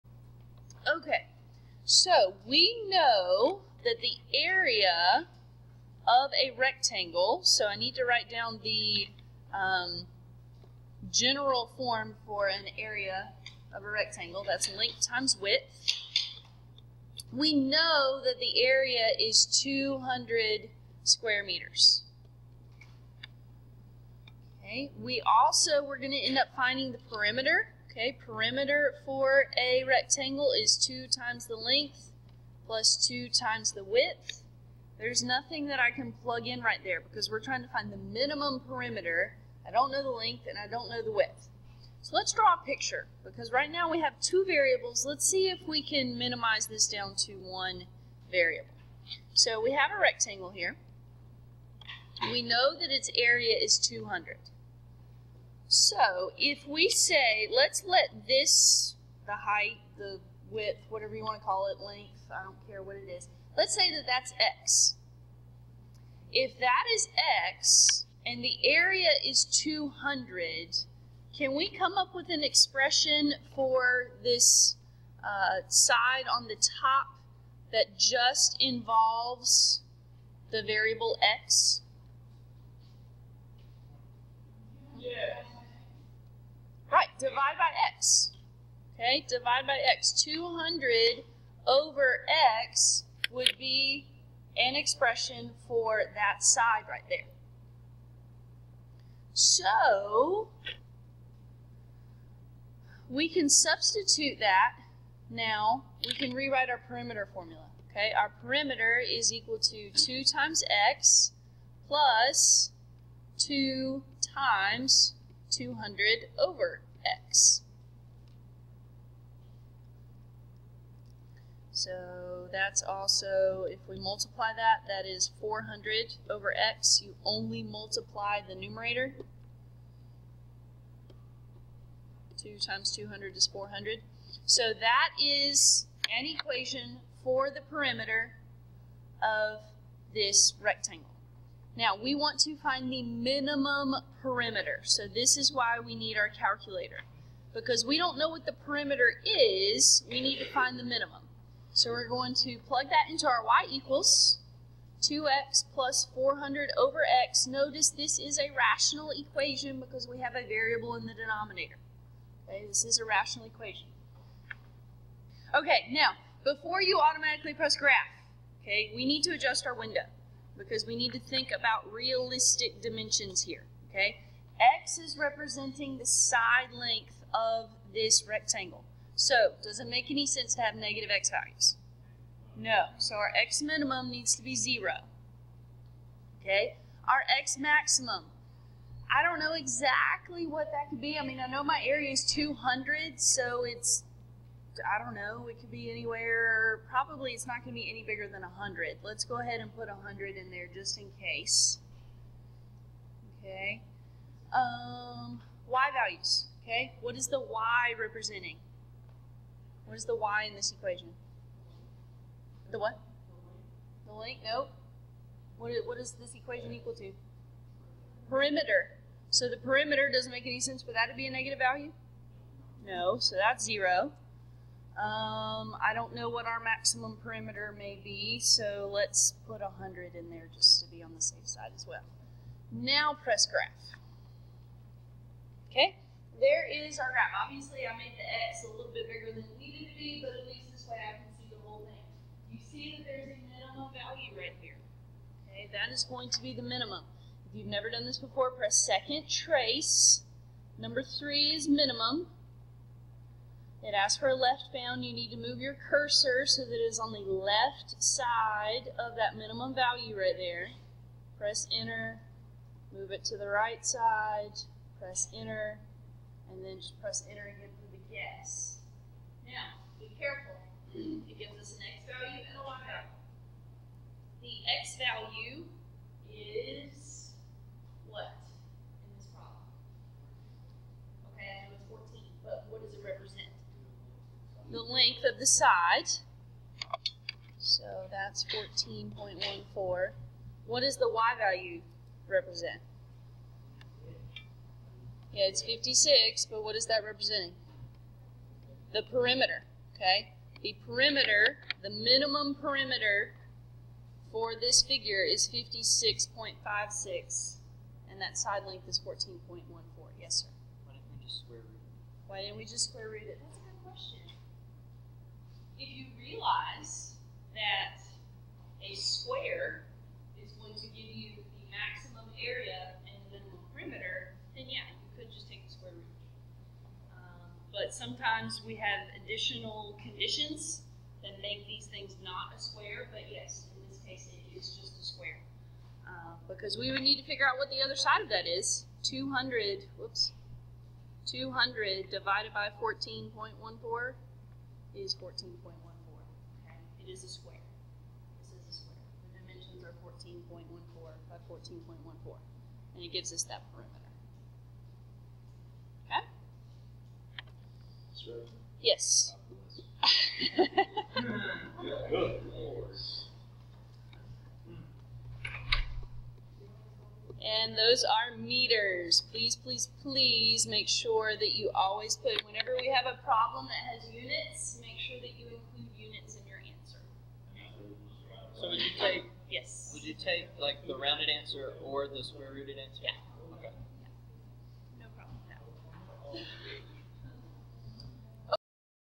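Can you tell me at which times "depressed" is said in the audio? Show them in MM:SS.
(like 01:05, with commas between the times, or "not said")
not said.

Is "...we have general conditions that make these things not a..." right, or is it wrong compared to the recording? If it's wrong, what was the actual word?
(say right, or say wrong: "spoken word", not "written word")
wrong: "additional", not "general".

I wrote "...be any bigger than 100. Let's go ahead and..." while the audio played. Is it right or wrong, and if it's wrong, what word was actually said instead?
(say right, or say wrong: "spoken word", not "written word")
right.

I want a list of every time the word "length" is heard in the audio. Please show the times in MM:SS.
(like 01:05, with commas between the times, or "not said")
00:14, 00:31, 00:40, 01:01, 02:56, 03:34, 04:44, 05:08.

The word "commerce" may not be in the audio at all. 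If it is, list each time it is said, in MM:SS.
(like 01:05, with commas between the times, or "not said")
not said.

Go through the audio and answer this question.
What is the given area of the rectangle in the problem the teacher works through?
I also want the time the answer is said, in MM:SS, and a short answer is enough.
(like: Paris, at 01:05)
200 square meters, at 00:19.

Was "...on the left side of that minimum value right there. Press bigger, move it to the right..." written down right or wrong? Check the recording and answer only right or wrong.
wrong.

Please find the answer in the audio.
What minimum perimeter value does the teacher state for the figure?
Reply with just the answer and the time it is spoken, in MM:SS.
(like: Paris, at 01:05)
56.56, at 05:05.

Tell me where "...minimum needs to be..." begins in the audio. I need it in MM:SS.
03:03.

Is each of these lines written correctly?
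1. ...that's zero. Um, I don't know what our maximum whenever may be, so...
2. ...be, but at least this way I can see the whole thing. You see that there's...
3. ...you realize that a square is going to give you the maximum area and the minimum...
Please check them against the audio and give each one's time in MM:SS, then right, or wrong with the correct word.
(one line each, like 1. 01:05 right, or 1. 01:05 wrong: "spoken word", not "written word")
1. 03:43 wrong: "perimeter", not "whenever"
2. 03:59 right
3. 05:15 right.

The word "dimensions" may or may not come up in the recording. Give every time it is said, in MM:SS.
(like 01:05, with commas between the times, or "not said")
02:52, 05:49.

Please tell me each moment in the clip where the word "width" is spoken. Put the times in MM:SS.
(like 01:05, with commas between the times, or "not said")
00:15, 00:33, 00:41, 01:00.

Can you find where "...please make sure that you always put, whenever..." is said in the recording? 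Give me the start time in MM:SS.
06:10.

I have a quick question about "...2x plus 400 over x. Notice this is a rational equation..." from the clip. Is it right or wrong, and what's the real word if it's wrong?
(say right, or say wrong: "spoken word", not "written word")
right.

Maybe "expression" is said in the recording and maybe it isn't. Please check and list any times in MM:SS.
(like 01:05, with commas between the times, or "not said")
01:12, 01:34.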